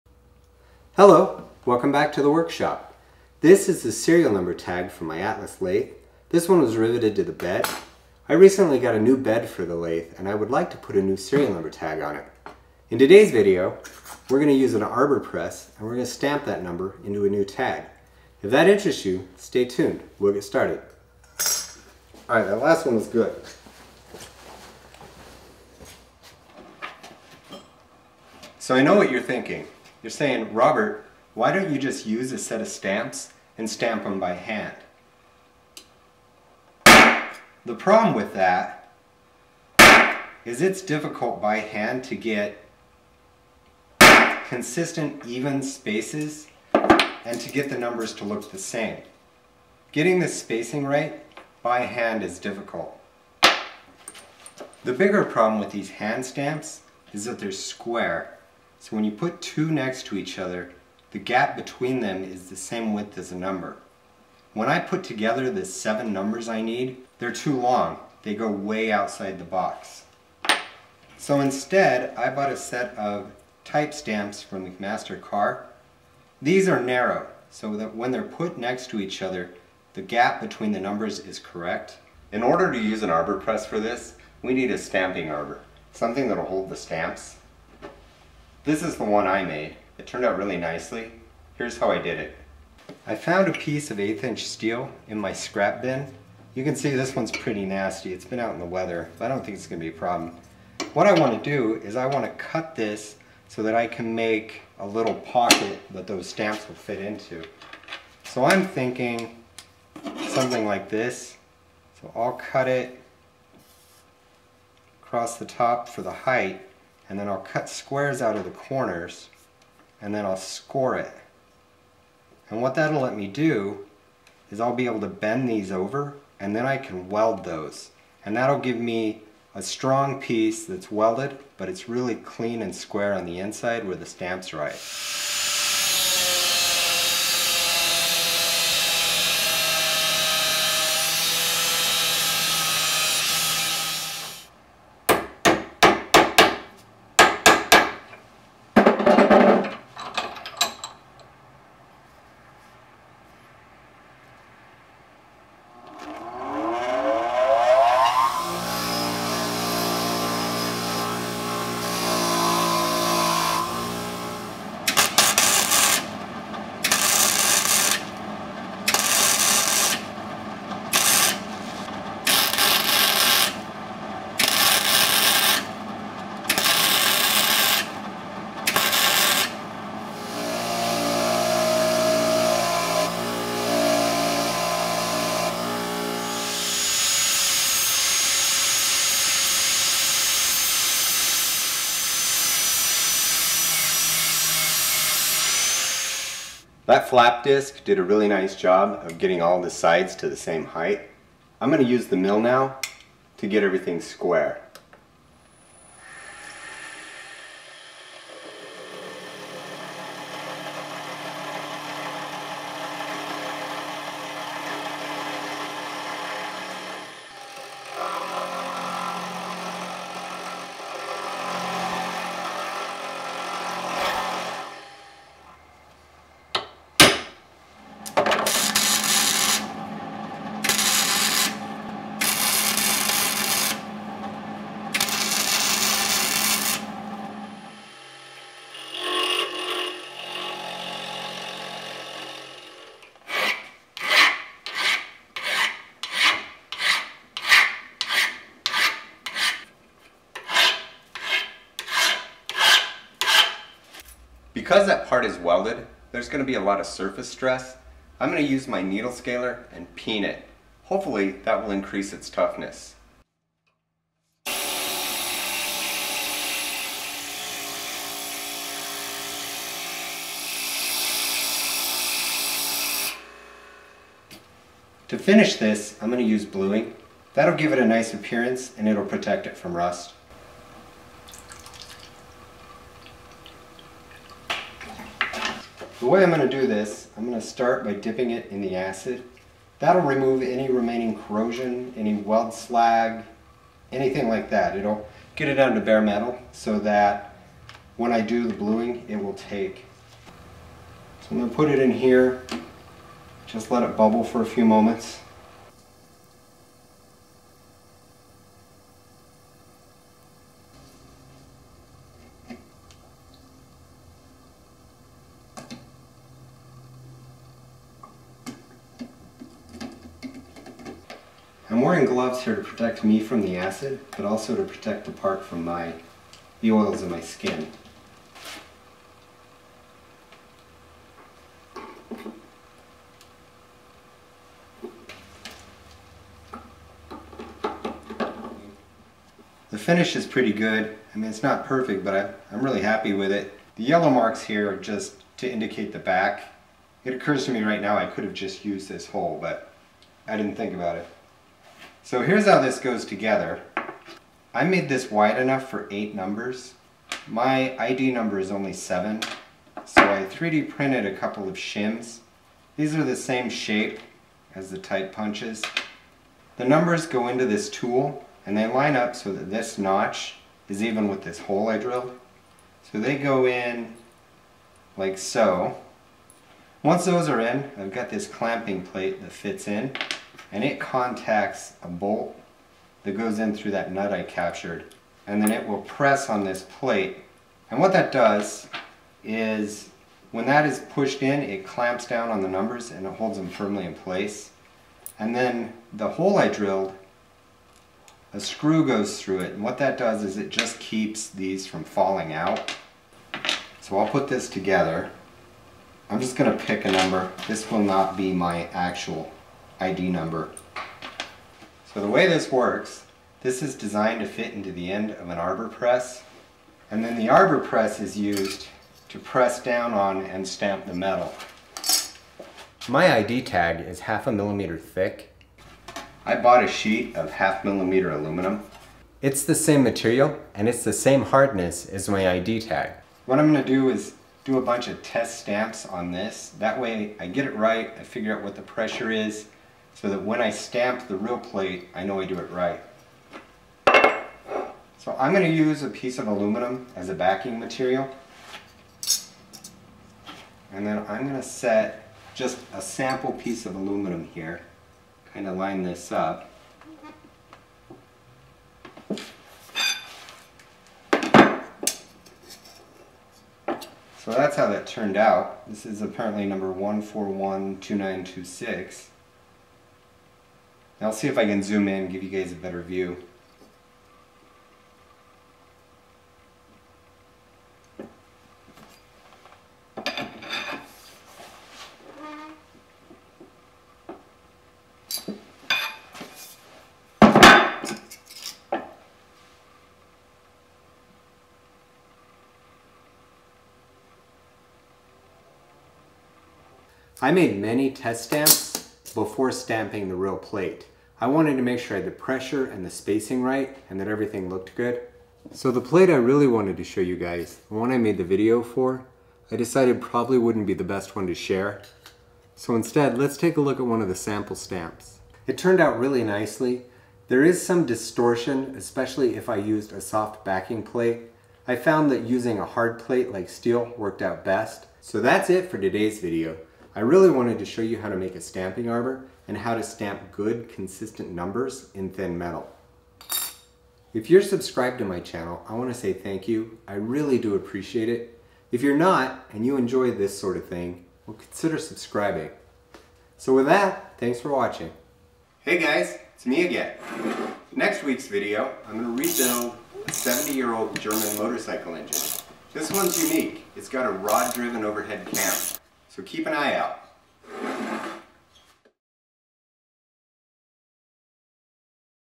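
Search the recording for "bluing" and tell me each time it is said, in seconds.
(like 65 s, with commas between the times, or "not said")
276 s, 298 s.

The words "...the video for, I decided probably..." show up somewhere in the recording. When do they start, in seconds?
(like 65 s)
508 s.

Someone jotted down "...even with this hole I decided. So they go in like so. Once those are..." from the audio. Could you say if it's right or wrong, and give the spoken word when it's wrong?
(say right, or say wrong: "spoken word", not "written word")
wrong: "drilled", not "decided".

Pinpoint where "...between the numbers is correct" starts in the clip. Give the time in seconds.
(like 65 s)
80 s.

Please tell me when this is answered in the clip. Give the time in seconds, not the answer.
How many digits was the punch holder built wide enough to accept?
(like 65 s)
355 s.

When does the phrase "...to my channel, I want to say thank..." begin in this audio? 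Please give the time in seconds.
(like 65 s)
534 s.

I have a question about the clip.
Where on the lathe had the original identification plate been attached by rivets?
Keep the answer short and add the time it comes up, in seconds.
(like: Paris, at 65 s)
the bed, at 6 s.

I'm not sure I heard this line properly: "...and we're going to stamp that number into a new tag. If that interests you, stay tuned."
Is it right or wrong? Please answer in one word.
right.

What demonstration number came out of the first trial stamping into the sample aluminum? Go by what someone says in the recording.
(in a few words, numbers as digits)
1412926.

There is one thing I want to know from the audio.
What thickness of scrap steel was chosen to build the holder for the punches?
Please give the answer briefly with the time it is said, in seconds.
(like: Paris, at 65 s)
1/8 inch, at 93 s.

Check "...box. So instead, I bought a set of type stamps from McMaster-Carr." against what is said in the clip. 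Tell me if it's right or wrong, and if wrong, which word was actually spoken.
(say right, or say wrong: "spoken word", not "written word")
right.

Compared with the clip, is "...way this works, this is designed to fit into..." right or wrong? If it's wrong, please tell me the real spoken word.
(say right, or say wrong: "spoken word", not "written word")
right.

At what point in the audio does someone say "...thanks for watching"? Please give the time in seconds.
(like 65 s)
544 s.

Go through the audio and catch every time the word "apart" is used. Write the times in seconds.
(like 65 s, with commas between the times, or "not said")
not said.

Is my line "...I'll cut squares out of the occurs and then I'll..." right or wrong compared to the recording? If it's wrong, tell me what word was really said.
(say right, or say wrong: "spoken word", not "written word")
wrong: "corners", not "occurs".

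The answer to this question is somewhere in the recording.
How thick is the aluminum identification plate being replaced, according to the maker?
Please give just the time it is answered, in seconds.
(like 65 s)
424 s.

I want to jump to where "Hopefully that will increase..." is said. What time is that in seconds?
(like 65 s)
260 s.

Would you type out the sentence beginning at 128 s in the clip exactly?
And that'll give me a strong piece that's welded, but it's really clean and square on the inside where the stamp's right.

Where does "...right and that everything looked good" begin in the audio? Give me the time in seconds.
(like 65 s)
503 s.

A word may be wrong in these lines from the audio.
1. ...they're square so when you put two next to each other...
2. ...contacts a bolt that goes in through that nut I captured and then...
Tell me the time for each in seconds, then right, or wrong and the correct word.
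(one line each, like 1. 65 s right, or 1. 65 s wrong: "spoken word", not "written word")
1. 57 s right
2. 380 s right.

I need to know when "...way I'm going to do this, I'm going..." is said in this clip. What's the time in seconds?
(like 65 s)
286 s.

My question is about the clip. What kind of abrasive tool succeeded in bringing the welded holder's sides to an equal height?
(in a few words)
flap disc.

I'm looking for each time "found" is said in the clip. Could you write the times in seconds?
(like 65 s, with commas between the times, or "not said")
93 s, 521 s.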